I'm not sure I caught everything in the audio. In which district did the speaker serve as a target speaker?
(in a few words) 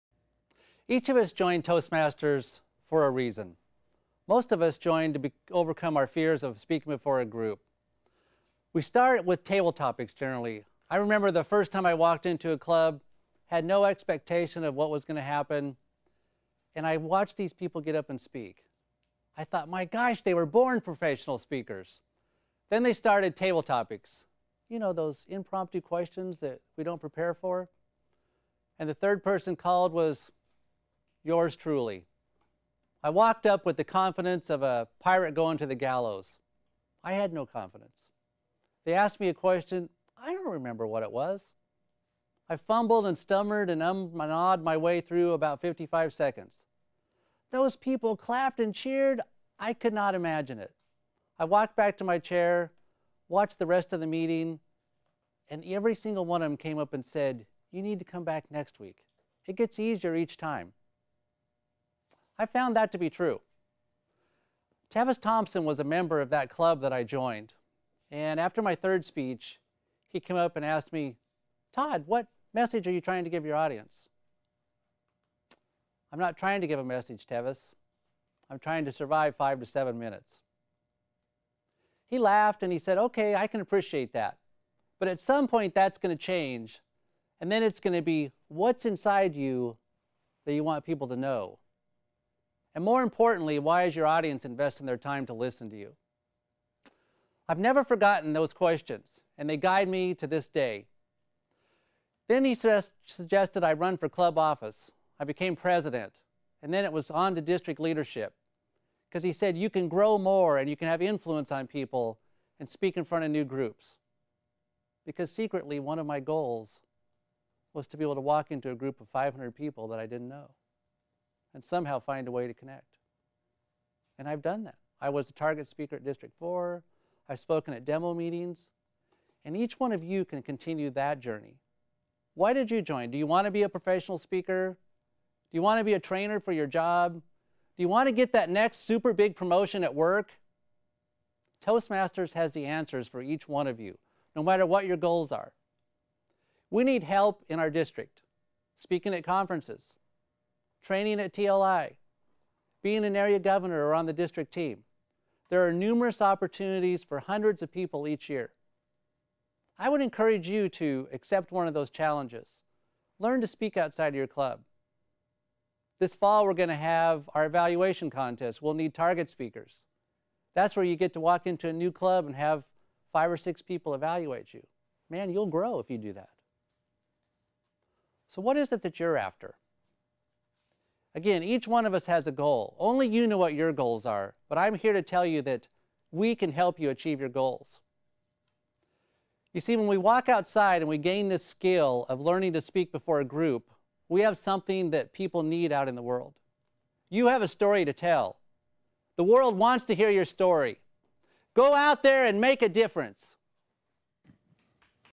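District 4.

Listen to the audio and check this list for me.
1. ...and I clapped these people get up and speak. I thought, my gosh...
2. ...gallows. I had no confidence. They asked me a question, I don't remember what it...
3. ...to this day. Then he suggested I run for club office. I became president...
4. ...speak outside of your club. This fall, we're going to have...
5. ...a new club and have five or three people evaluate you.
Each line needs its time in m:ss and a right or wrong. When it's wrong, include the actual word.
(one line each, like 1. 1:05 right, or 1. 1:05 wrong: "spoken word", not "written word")
1. 0:16 wrong: "watched", not "clapped"
2. 0:35 right
3. 1:40 right
4. 2:43 right
5. 2:51 wrong: "six", not "three".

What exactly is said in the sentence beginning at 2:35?
There are numerous opportunities for hundreds of people each year.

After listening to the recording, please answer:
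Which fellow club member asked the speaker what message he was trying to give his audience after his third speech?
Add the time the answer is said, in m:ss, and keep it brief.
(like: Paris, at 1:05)
Tevis Thompson, at 1:04.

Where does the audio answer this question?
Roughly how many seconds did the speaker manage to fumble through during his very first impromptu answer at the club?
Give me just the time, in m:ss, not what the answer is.
0:45.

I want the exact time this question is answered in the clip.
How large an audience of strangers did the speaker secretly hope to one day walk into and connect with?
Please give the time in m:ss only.
1:59.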